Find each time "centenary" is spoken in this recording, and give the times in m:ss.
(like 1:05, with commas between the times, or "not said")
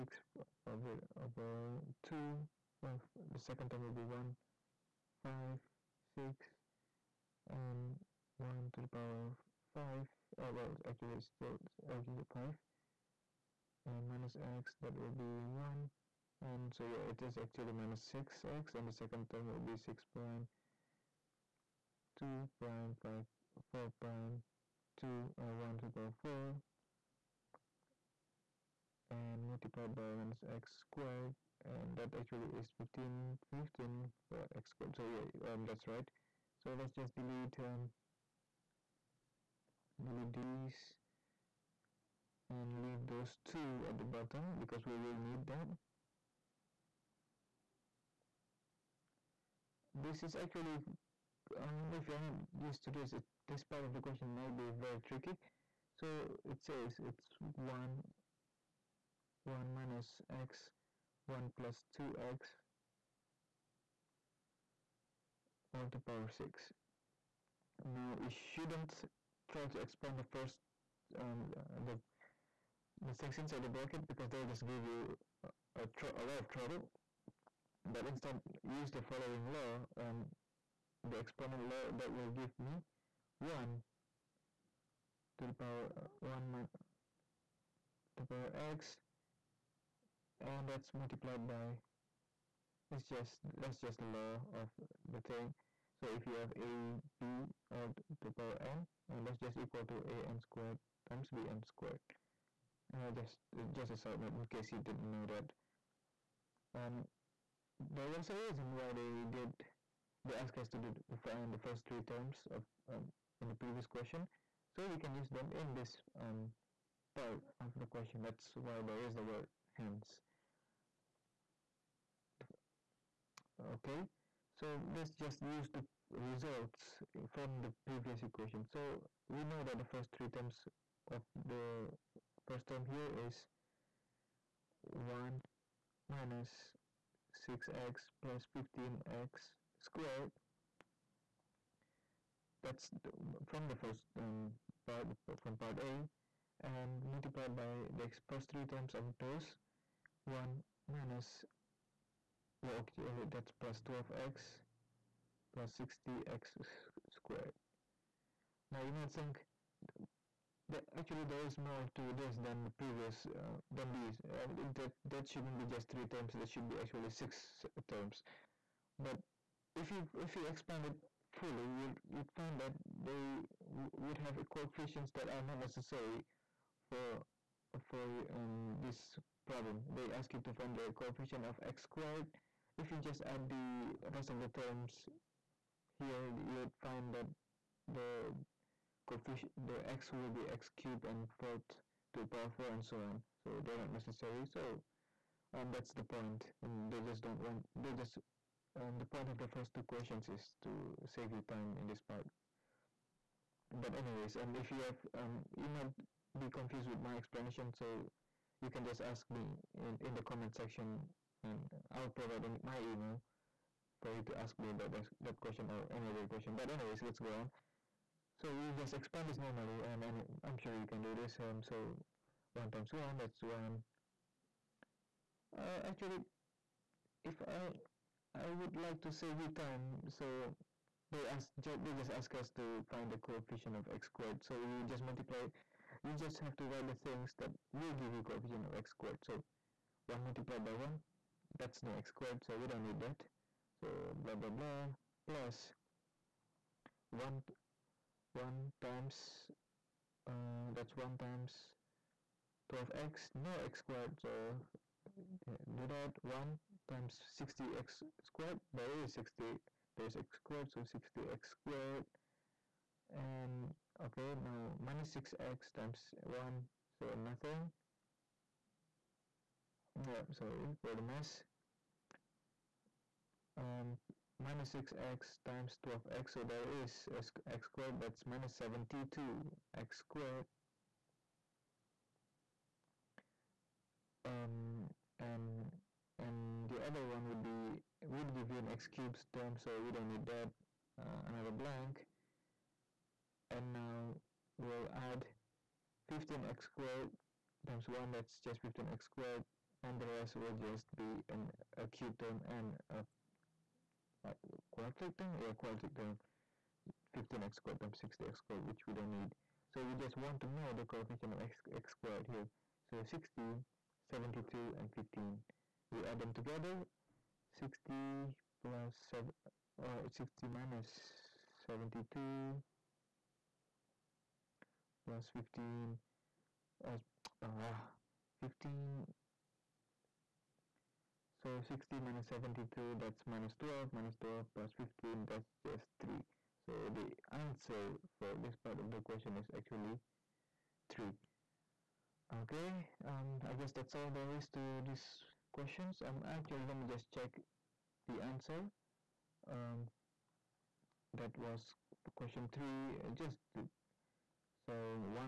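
not said.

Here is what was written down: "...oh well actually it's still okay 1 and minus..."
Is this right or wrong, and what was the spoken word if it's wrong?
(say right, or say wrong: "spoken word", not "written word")
wrong: "5", not "1".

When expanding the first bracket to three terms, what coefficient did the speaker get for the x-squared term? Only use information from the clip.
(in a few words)
15.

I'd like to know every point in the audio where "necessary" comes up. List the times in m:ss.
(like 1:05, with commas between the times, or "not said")
2:55, 3:13.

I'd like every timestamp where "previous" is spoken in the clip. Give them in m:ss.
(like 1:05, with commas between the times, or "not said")
1:53, 2:07, 2:42.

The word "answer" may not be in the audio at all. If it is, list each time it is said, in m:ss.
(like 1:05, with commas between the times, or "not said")
5:37, 5:48.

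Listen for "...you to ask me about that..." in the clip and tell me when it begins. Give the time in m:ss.
3:34.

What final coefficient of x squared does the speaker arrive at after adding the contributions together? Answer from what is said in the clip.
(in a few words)
3.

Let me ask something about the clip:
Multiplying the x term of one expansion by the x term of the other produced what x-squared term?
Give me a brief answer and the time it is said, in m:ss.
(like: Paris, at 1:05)
-72x squared, at 4:38.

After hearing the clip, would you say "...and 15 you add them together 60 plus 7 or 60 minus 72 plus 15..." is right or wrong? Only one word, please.
right.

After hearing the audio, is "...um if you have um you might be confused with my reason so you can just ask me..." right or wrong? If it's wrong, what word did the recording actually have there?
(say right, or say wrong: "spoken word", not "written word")
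wrong: "explanation", not "reason".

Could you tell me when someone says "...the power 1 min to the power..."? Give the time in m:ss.
1:25.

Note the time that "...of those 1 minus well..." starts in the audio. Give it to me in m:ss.
2:28.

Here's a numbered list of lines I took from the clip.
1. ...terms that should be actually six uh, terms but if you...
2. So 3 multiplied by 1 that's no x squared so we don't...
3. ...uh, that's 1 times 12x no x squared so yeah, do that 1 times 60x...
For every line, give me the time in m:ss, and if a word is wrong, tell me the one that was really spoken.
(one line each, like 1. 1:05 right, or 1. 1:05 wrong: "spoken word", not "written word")
1. 2:46 right
2. 3:59 wrong: "1", not "3"
3. 4:10 right.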